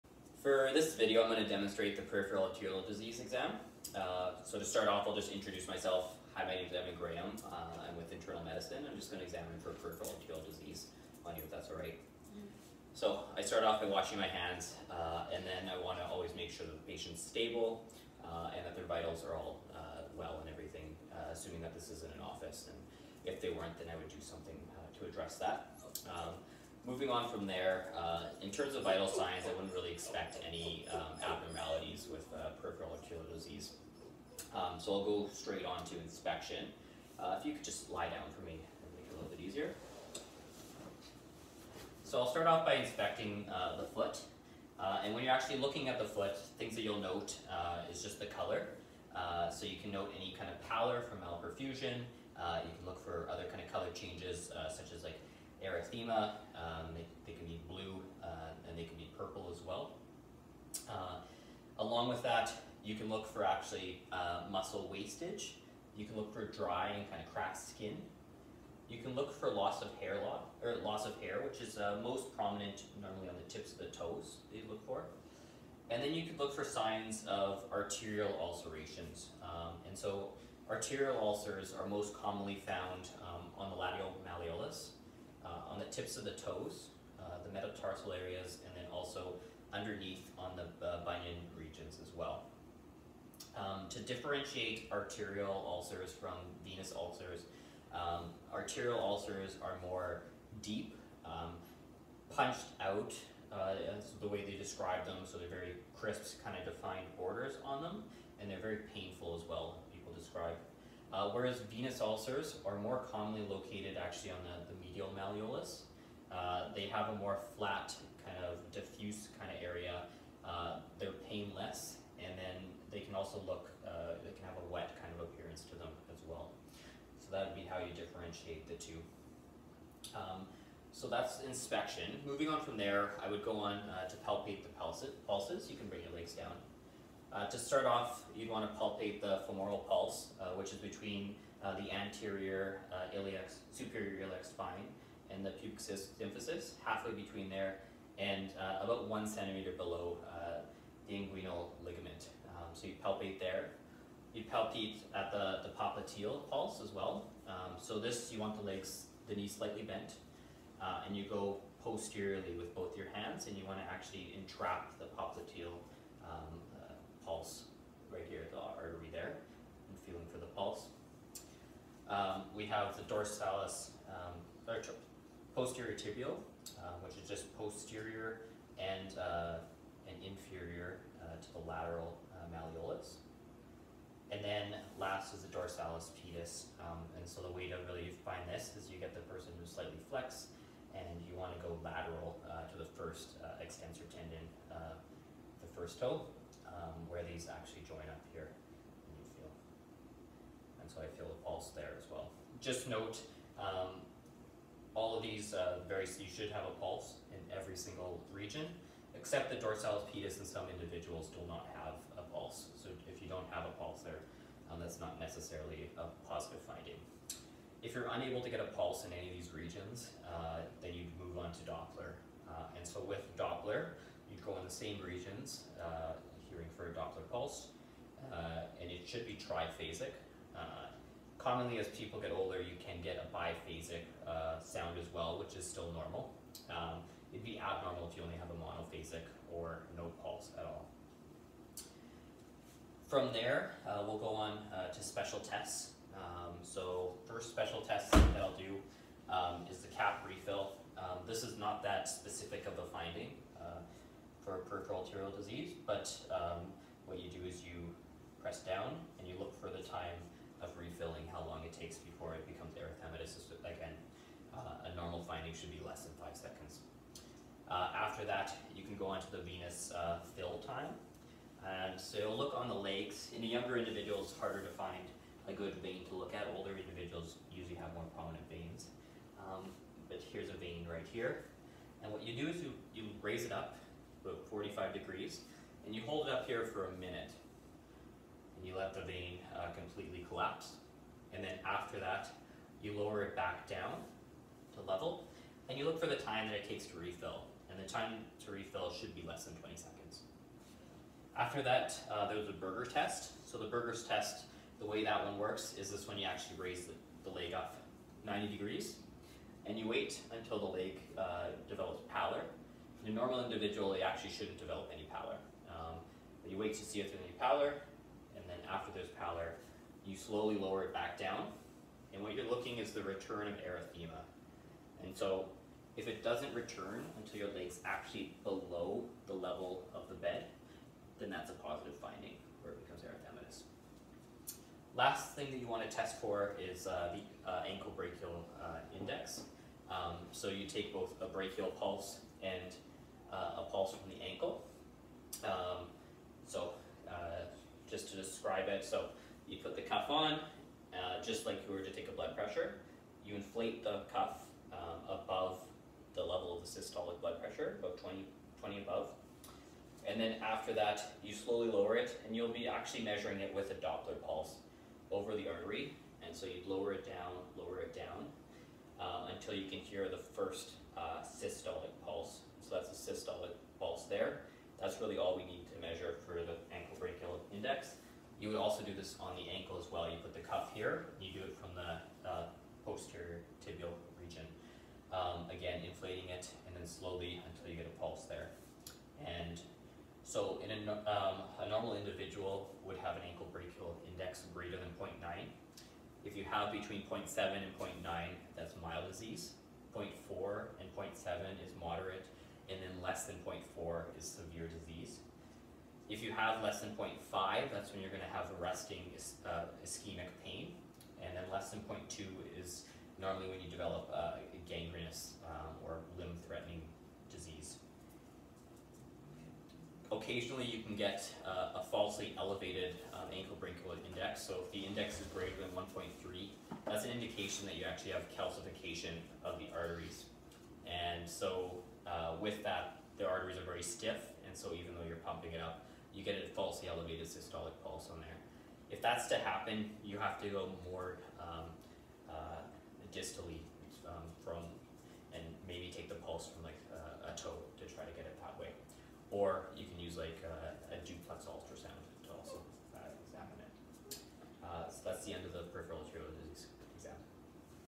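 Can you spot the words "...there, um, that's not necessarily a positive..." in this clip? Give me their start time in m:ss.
3:34.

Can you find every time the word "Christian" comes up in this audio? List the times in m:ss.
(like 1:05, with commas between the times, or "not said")
not said.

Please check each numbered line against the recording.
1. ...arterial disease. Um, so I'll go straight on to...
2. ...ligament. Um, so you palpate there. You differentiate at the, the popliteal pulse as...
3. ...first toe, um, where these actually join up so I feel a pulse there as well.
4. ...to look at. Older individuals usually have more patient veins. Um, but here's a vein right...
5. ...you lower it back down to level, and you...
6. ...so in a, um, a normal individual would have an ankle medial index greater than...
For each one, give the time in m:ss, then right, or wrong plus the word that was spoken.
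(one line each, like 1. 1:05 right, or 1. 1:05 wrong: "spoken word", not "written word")
1. 0:32 right
2. 2:31 wrong: "palpate", not "differentiate"
3. 3:15 right
4. 4:36 wrong: "prominent", not "patient"
5. 4:52 right
6. 6:30 wrong: "brachial", not "medial".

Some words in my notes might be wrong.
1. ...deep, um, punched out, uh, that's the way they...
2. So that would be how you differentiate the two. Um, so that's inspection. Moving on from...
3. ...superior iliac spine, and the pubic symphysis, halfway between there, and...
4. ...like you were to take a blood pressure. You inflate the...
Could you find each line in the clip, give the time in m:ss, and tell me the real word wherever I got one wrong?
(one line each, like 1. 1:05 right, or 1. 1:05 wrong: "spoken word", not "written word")
1. 1:40 right
2. 2:07 right
3. 2:23 right
4. 5:51 right.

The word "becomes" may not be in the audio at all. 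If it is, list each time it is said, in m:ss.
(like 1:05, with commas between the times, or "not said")
4:22, 5:32.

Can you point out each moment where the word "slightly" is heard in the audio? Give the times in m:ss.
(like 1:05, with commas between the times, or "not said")
2:39, 3:09.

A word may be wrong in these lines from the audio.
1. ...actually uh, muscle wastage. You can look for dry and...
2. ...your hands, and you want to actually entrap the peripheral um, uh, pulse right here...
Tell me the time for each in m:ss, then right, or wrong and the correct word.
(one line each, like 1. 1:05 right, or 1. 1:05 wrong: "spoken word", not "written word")
1. 1:03 right
2. 2:42 wrong: "popliteal", not "peripheral".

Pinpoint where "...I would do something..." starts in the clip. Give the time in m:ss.
0:23.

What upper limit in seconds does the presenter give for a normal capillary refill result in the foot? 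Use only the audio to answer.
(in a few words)
5 seconds.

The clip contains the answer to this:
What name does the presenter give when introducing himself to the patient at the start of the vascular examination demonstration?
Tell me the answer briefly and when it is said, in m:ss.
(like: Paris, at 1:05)
Evan Graham, at 0:06.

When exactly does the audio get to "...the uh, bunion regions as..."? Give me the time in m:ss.
1:30.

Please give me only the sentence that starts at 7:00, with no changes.
Occasionally you can get uh, a falsely elevated um, ankle brachial index.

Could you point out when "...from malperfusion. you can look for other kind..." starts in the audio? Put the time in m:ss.
0:51.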